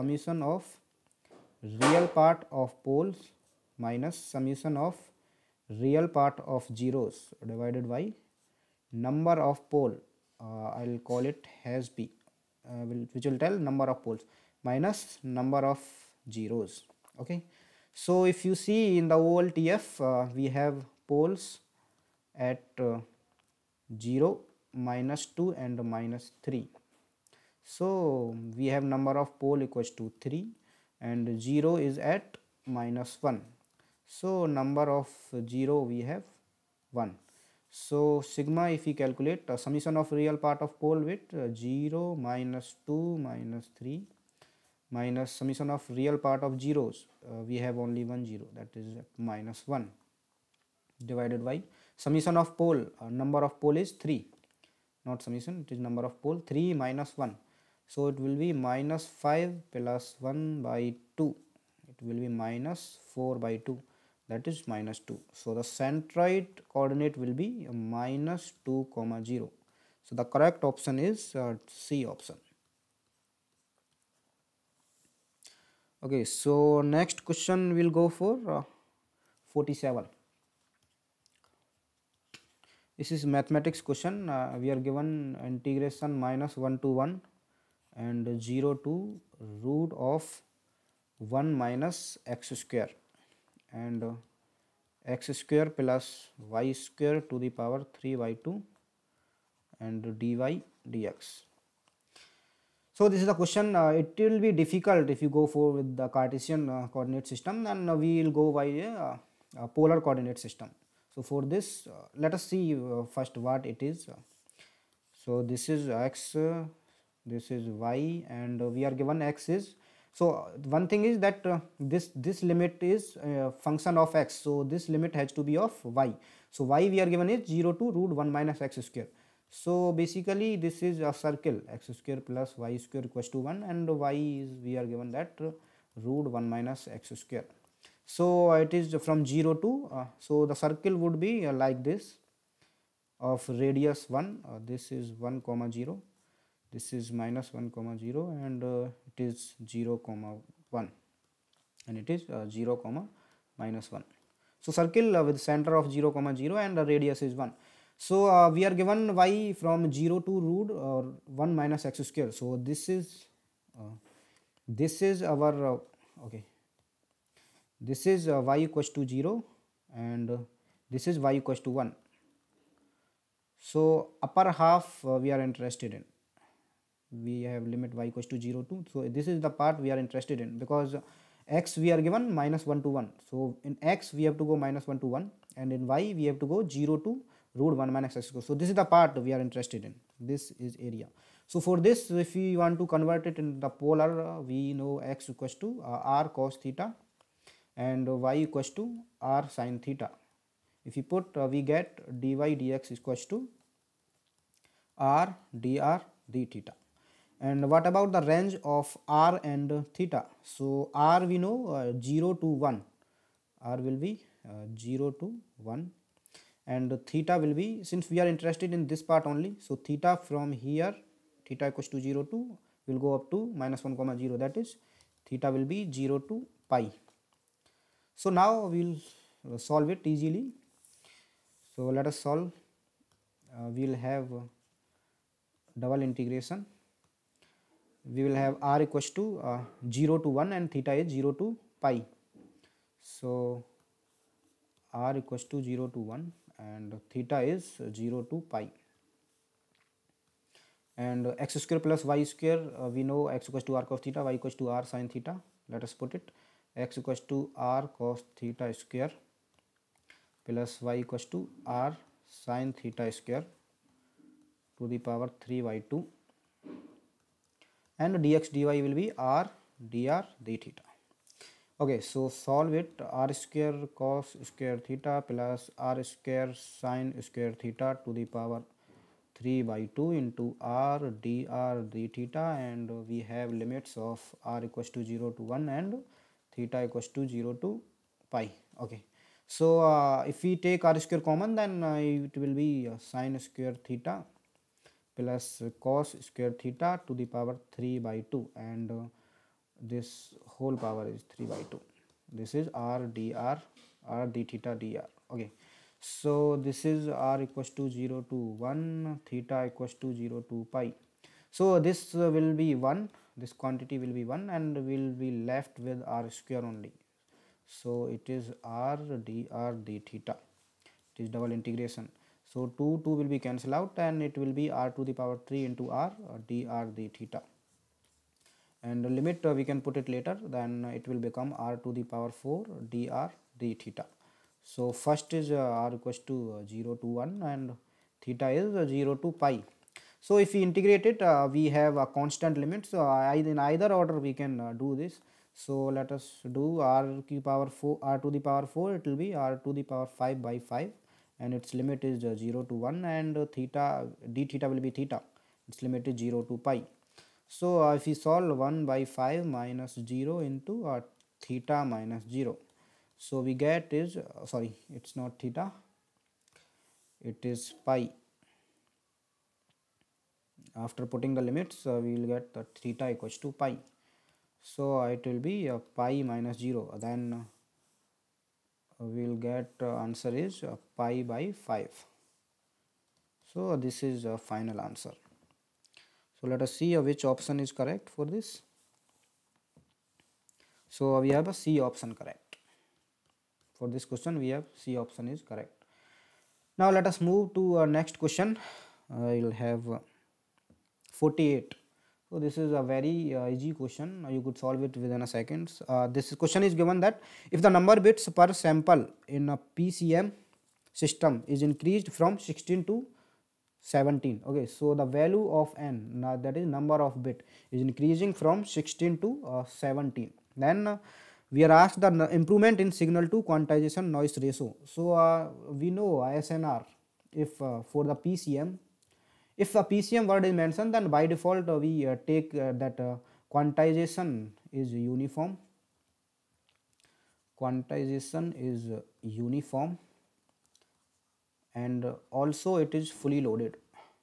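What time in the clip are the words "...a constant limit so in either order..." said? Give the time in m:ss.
5:41.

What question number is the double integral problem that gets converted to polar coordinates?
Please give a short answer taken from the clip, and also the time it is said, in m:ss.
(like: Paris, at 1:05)
47, at 1:19.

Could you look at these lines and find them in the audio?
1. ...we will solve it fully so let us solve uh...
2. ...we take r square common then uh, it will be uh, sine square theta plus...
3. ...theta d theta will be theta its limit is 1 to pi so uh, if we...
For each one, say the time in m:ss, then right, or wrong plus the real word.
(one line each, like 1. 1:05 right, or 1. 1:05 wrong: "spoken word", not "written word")
1. 3:48 wrong: "easily", not "fully"
2. 4:50 right
3. 5:53 wrong: "0", not "1".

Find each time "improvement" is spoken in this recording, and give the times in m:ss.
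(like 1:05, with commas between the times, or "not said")
7:02.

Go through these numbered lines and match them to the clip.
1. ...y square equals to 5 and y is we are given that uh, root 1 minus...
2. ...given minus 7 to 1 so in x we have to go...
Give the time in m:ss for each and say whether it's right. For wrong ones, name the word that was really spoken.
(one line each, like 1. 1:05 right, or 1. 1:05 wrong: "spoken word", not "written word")
1. 2:12 wrong: "1", not "5"
2. 3:02 wrong: "1", not "7".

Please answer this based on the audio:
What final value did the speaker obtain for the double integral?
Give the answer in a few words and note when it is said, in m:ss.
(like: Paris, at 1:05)
pi/5, at 6:20.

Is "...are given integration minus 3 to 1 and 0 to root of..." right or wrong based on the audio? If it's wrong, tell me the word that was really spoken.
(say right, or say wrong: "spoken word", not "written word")
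wrong: "1", not "3".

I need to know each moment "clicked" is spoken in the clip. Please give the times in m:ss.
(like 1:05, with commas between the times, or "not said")
not said.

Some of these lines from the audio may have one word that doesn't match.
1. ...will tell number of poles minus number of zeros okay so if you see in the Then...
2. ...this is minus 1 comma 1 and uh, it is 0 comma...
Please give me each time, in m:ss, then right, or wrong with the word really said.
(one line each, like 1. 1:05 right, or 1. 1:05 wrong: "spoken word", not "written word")
1. 0:13 wrong: "OLTF", not "Then"
2. 2:26 wrong: "0", not "1".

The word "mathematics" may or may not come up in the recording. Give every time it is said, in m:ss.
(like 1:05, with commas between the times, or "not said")
1:23.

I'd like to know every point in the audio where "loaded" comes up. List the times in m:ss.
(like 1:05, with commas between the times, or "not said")
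7:23.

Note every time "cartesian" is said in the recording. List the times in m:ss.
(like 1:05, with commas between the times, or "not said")
1:46.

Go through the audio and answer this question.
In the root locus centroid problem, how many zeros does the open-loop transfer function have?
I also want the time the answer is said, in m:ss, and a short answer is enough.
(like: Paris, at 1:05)
1, at 0:34.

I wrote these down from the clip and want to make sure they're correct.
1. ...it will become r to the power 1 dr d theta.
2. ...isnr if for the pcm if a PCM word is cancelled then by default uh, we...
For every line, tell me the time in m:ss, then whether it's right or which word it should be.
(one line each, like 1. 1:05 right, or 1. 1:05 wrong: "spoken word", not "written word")
1. 5:30 wrong: "4", not "1"
2. 7:06 wrong: "mentioned", not "cancelled".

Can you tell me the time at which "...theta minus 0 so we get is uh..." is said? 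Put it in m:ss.
6:01.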